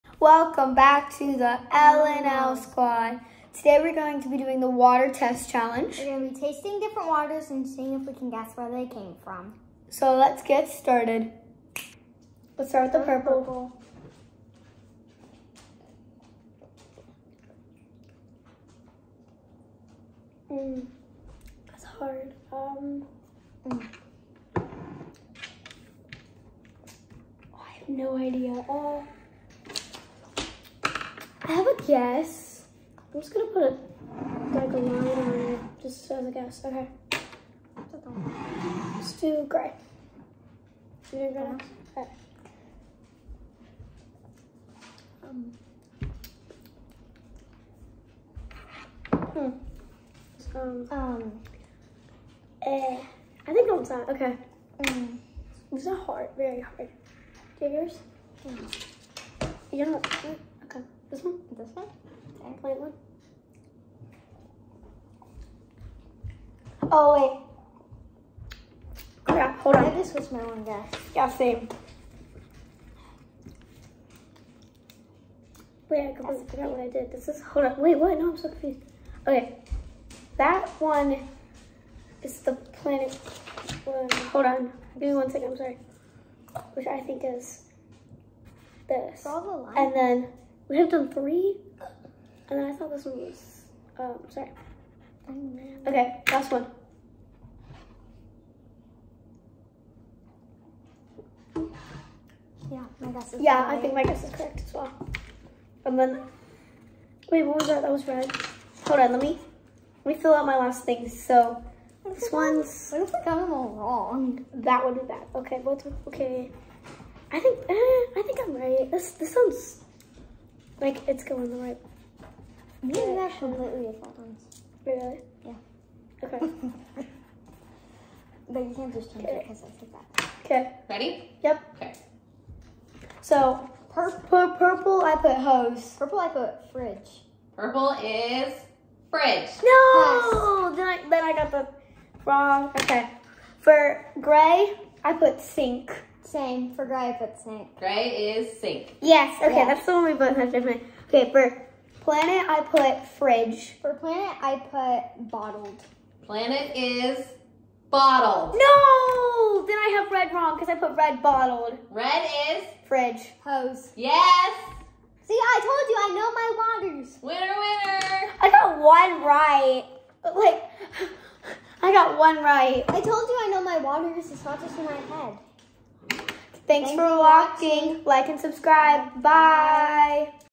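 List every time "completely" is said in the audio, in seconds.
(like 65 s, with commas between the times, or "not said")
76 s, 123 s.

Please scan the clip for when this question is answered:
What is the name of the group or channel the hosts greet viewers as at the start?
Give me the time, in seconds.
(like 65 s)
1 s.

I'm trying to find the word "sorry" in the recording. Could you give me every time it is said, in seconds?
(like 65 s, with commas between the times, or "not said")
85 s, 94 s.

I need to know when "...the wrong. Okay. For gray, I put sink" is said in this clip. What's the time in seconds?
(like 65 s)
141 s.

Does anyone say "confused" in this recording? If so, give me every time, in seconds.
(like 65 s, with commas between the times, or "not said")
78 s.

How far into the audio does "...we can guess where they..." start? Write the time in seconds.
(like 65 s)
8 s.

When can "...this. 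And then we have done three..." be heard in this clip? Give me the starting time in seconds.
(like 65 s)
88 s.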